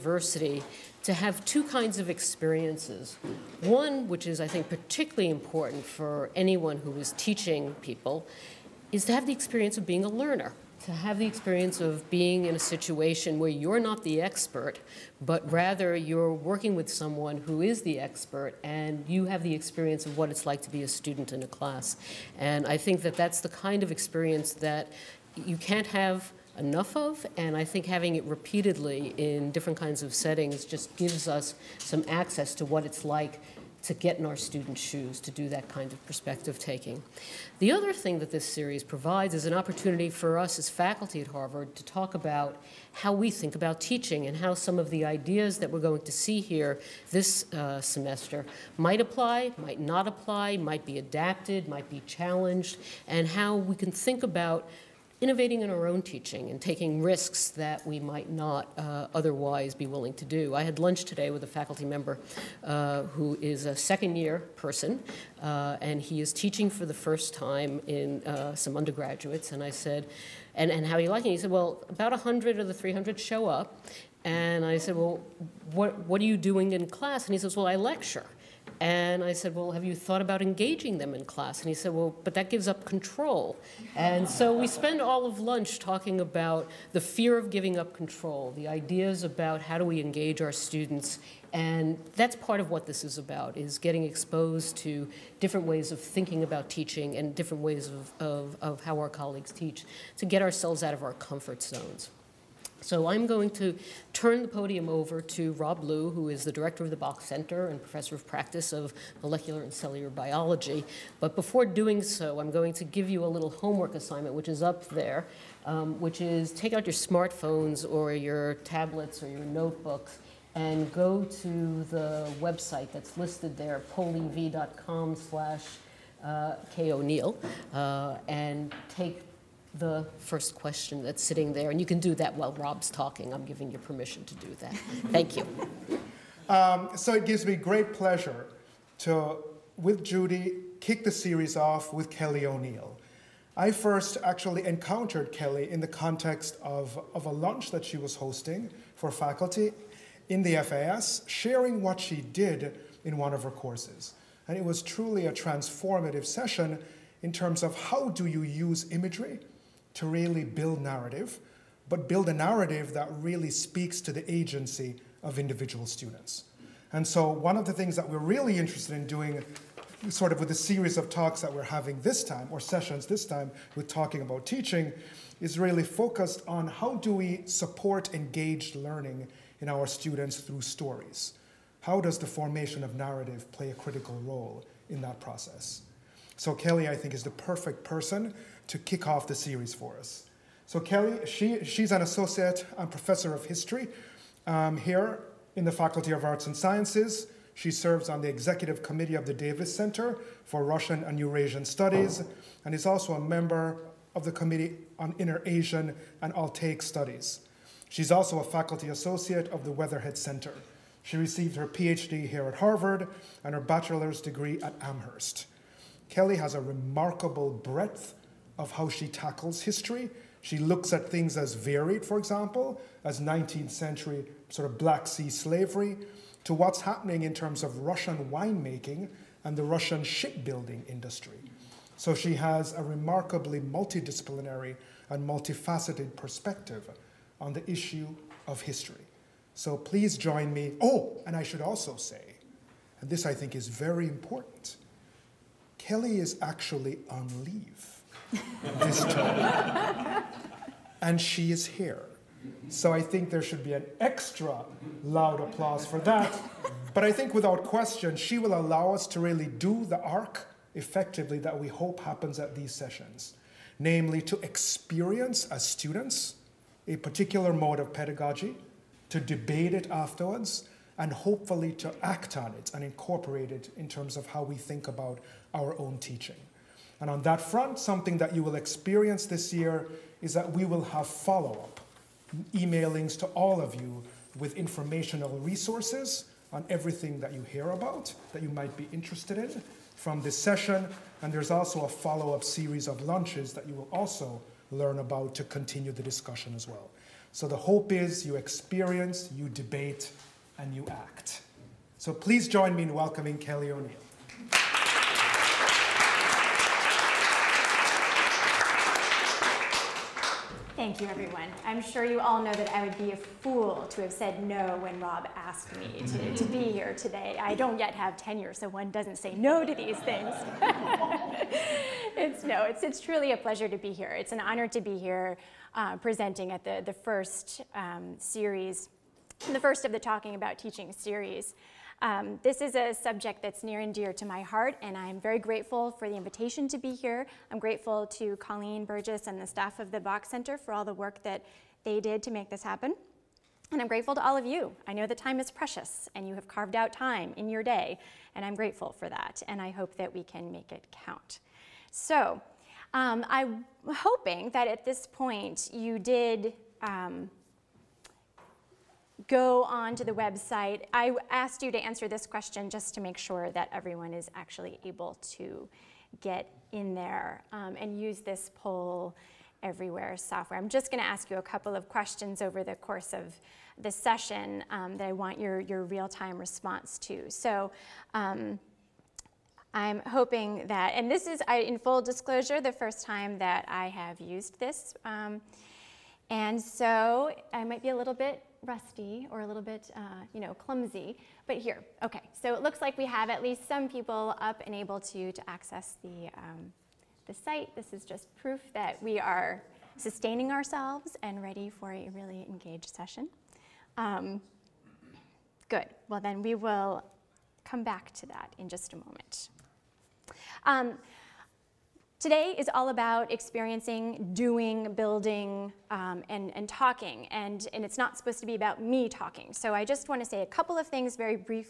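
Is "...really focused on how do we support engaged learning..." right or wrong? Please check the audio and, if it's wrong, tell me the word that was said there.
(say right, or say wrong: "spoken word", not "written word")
right.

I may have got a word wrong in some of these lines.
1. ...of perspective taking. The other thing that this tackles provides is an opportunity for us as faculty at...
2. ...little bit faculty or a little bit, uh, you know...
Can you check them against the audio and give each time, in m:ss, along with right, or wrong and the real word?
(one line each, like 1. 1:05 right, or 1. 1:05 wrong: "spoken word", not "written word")
1. 0:35 wrong: "series", not "tackles"
2. 6:27 wrong: "rusty", not "faculty".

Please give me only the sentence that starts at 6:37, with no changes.
This is just proof that we are sustaining ourselves and ready for a really engaged session.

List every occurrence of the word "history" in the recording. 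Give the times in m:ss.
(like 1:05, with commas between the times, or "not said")
3:13, 3:39, 3:58.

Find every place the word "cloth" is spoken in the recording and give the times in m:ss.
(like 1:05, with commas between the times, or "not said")
not said.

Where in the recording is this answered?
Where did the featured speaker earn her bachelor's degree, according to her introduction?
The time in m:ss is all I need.
3:34.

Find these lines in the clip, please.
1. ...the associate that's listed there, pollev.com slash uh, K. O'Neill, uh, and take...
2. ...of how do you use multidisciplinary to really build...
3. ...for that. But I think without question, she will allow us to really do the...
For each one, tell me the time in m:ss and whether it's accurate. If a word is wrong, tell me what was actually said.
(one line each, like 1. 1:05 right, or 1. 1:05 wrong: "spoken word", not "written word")
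1. 2:01 wrong: "website", not "associate"
2. 2:37 wrong: "imagery", not "multidisciplinary"
3. 4:15 right.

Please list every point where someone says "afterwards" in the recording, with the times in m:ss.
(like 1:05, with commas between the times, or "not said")
4:29.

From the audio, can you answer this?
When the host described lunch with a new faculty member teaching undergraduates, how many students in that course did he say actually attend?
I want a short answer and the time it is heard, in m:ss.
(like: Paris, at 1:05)
100, at 1:11.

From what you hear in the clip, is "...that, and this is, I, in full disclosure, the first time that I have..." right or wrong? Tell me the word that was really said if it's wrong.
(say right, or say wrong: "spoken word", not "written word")
right.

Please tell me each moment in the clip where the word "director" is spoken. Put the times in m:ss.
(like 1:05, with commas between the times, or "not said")
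1:46.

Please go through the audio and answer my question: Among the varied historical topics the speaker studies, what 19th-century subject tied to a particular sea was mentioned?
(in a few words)
Black Sea slavery.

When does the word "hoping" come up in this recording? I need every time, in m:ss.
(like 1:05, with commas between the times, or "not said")
5:53, 6:20.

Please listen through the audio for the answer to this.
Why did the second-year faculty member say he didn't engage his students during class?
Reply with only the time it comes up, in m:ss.
1:22.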